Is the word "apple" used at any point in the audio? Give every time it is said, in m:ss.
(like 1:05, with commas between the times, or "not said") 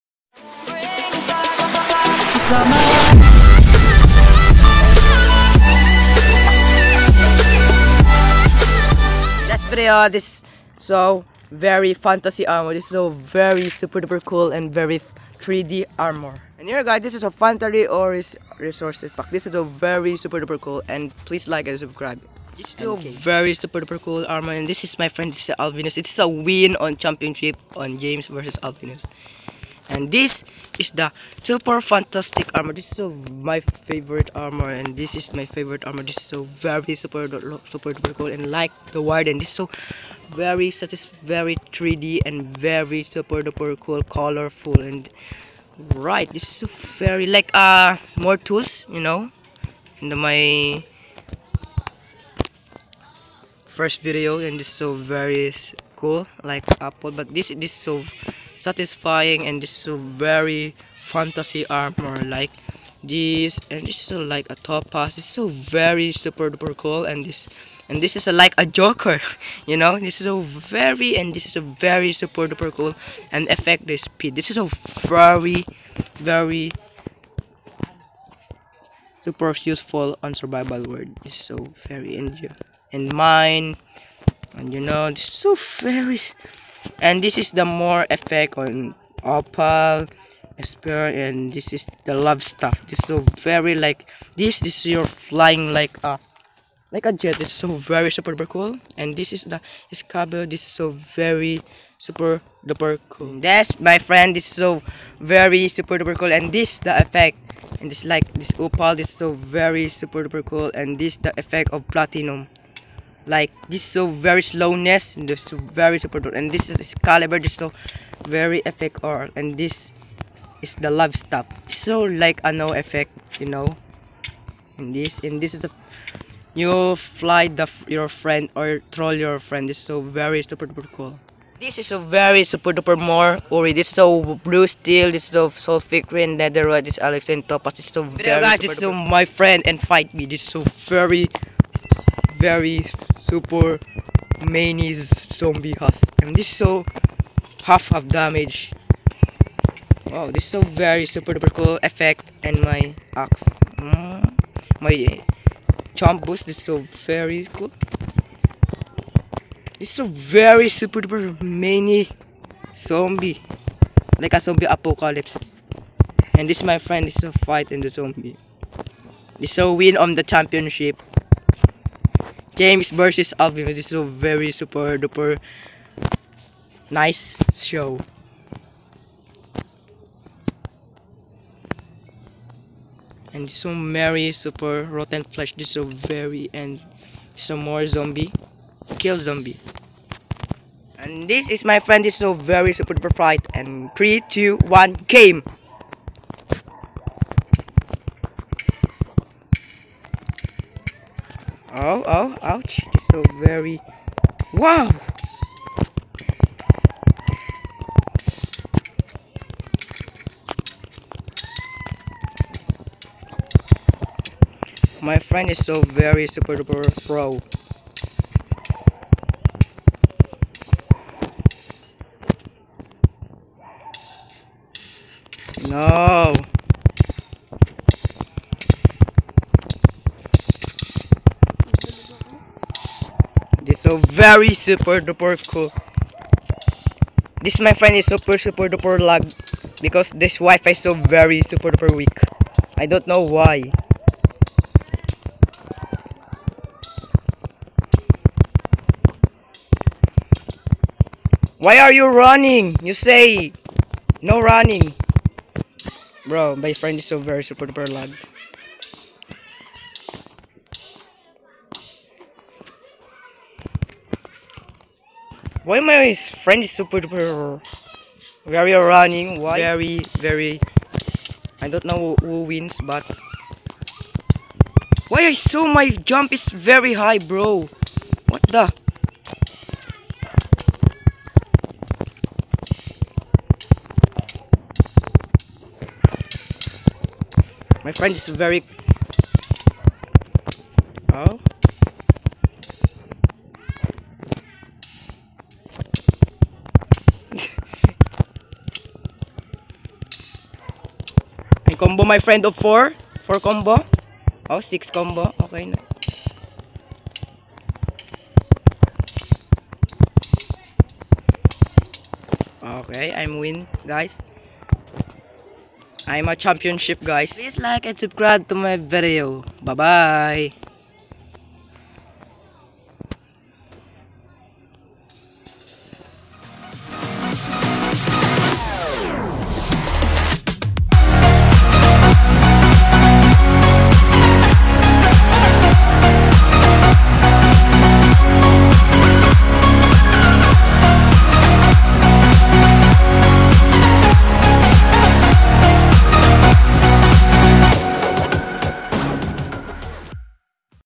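0:56.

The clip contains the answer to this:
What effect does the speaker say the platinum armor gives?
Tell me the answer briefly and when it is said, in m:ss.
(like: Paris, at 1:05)
slowness, at 1:54.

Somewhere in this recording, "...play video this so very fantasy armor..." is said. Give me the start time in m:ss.
0:09.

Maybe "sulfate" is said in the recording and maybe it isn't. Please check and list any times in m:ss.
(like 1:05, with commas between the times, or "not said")
2:15.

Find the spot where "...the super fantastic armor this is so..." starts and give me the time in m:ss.
0:30.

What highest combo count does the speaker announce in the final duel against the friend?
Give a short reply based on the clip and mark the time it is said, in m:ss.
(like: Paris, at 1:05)
6, at 5:04.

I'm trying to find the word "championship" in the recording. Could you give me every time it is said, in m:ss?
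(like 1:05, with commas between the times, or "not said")
0:26, 2:50, 5:16.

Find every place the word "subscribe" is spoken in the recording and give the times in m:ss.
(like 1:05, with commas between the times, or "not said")
0:21, 5:17.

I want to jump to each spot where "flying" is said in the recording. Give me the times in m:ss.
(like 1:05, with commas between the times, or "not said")
1:35.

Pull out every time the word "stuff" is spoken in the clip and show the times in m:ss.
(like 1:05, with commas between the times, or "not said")
1:32, 2:01.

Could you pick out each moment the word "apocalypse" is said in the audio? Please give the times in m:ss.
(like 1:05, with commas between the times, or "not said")
2:44.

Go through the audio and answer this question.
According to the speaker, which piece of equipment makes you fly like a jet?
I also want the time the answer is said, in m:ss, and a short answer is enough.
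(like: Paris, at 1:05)
opal spear, at 1:29.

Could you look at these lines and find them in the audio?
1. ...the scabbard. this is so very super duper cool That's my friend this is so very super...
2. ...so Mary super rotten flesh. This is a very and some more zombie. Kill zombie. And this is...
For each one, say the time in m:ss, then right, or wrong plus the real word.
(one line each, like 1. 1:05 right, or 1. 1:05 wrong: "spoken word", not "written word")
1. 1:39 right
2. 3:03 right.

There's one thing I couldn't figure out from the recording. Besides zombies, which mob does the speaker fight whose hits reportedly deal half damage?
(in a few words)
husk.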